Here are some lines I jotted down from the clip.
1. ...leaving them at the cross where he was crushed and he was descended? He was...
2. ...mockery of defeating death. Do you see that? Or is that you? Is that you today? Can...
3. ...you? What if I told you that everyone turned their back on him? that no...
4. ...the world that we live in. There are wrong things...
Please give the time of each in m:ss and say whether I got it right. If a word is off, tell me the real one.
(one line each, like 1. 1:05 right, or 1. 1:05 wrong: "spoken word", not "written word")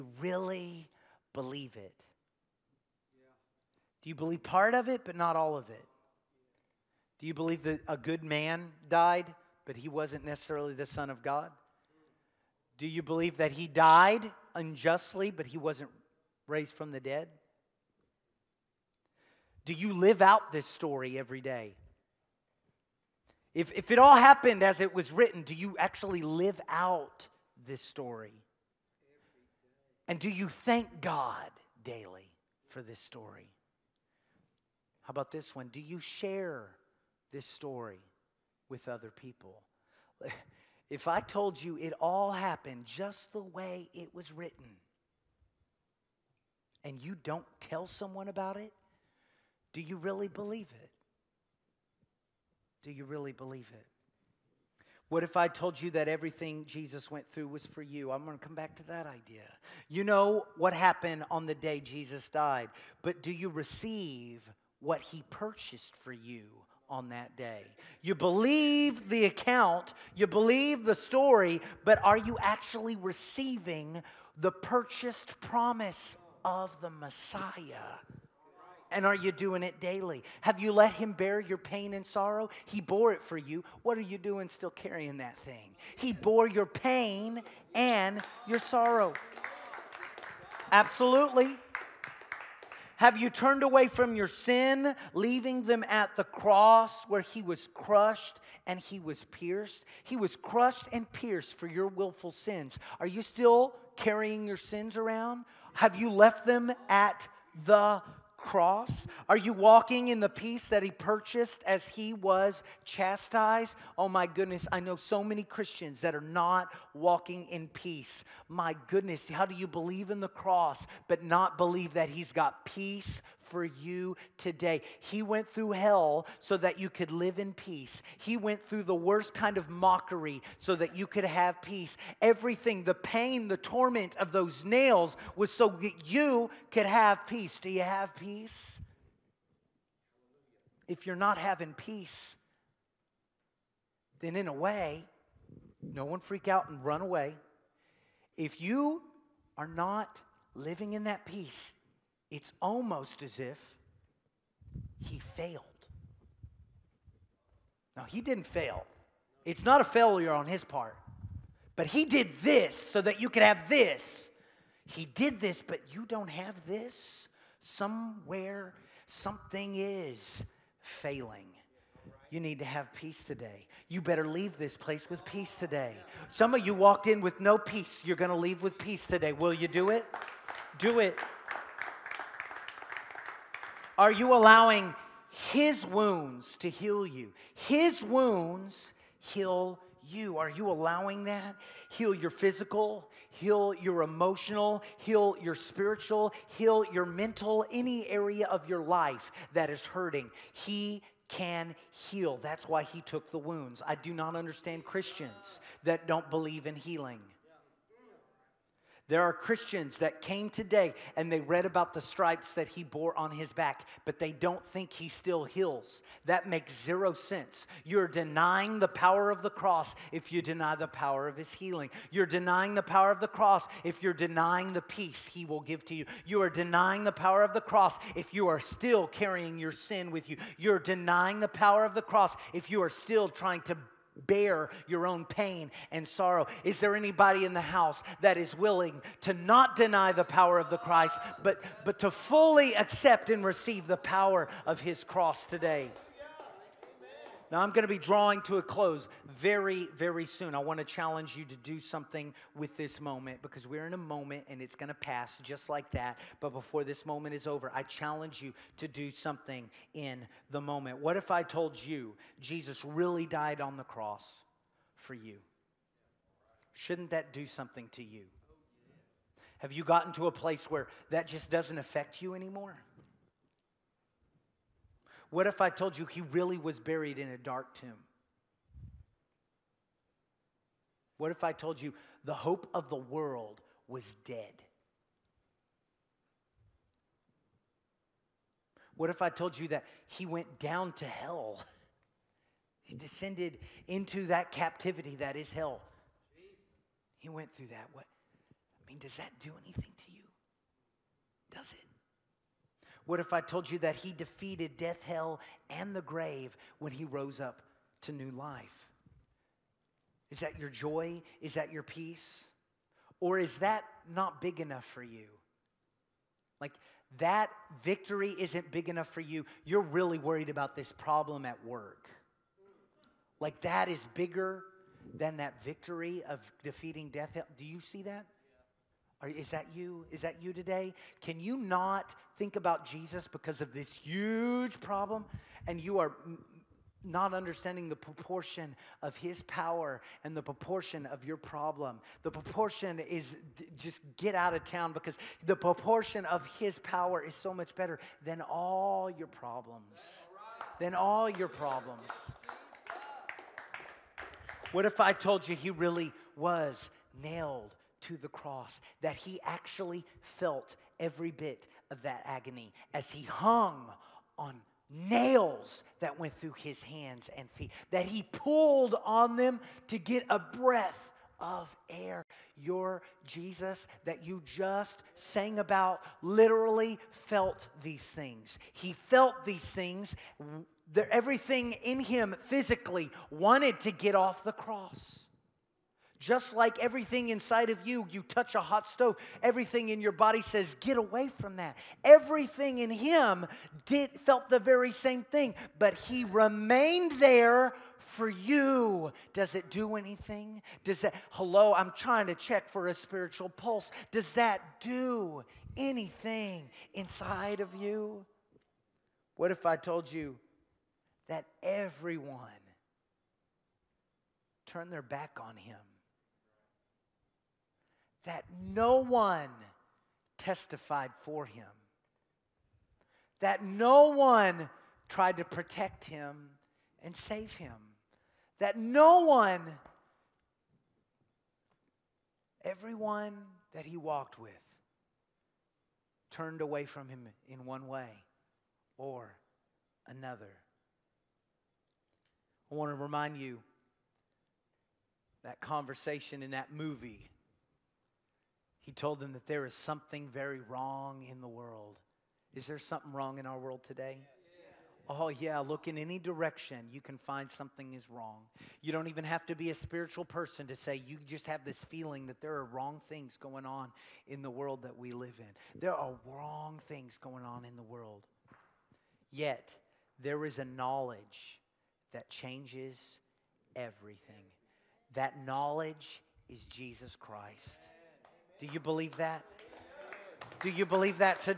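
1. 1:35 wrong: "pierced", not "descended"
2. 5:25 wrong: "victory", not "mockery"
3. 6:47 right
4. 7:44 right.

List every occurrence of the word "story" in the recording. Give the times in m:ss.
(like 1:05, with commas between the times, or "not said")
0:20, 0:27, 0:32, 0:37, 1:10.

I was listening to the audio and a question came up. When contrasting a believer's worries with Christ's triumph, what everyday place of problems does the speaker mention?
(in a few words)
work.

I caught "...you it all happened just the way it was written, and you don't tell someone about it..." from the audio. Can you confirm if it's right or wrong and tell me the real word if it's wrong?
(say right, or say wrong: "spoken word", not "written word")
right.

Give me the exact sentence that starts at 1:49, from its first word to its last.
Are you walking in the peace that he purchased as he was chastised?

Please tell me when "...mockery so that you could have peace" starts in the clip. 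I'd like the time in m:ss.
2:09.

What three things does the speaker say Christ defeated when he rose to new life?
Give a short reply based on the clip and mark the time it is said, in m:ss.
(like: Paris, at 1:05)
death, hell, and the grave, at 5:04.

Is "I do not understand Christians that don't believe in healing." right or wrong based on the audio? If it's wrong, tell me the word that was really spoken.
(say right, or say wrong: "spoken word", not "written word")
right.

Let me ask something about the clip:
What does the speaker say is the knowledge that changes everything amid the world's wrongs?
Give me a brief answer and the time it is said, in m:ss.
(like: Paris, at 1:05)
Jesus Christ, at 7:55.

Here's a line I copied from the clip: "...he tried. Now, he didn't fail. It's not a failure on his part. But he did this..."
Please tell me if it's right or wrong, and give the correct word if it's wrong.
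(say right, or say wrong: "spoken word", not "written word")
wrong: "failed", not "tried".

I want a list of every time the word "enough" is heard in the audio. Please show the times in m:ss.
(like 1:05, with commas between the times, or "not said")
5:14, 5:18.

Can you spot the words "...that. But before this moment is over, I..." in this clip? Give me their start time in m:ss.
4:15.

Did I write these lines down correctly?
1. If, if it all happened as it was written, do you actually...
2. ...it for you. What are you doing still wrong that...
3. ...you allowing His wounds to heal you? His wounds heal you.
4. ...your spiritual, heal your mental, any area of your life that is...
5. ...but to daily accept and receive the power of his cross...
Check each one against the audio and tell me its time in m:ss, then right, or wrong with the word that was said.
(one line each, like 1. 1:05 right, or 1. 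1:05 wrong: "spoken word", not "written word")
1. 0:23 right
2. 1:23 wrong: "carrying", not "wrong"
3. 3:04 right
4. 3:15 right
5. 4:01 wrong: "fully", not "daily".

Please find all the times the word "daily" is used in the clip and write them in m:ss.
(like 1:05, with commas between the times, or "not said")
0:31, 1:19.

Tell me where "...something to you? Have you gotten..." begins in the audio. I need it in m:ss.
4:27.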